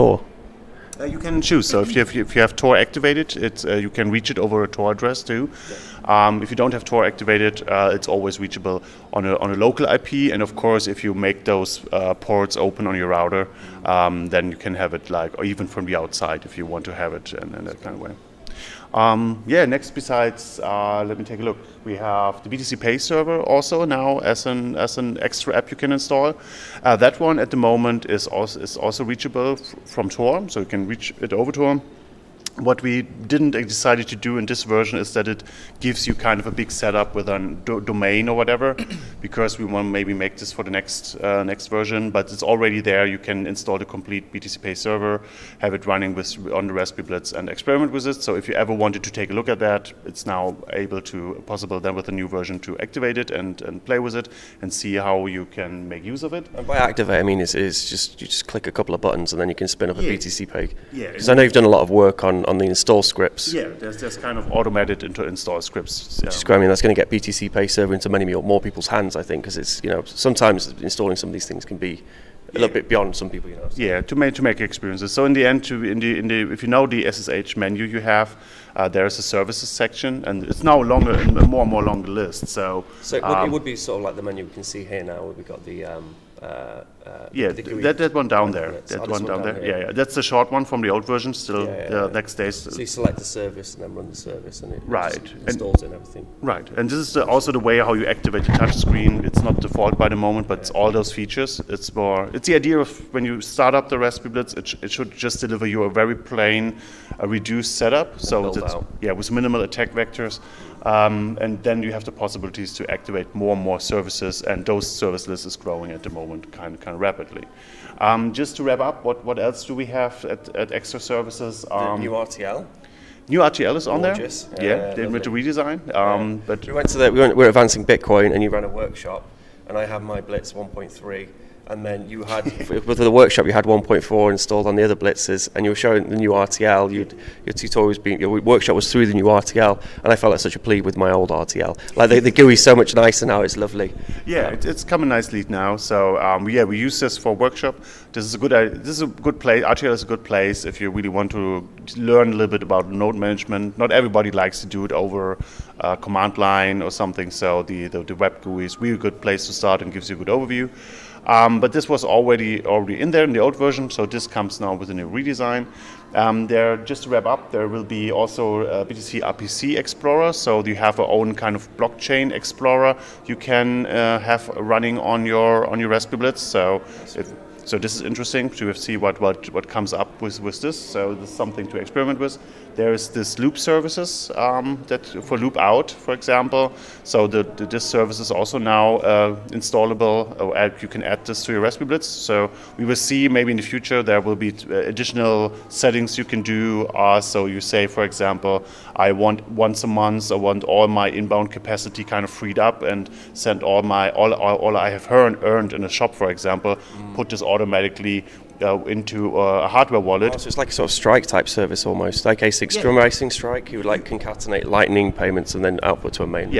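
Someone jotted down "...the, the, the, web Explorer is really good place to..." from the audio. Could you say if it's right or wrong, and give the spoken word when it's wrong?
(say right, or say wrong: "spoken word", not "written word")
wrong: "GUI", not "Explorer".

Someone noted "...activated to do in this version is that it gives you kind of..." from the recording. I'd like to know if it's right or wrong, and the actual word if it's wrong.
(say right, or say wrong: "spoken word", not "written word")
wrong: "decided", not "activated".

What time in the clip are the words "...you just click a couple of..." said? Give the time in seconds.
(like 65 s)
58 s.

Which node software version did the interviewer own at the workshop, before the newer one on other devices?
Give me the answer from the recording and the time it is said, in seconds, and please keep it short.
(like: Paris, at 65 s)
1.3, at 130 s.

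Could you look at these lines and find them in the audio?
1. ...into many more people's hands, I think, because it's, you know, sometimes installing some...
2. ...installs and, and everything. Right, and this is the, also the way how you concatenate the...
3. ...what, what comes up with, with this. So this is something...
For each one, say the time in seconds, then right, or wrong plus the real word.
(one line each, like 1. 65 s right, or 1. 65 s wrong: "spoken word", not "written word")
1. 67 s right
2. 95 s wrong: "activate", not "concatenate"
3. 179 s right.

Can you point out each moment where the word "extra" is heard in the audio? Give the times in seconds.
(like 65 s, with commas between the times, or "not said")
25 s, 120 s.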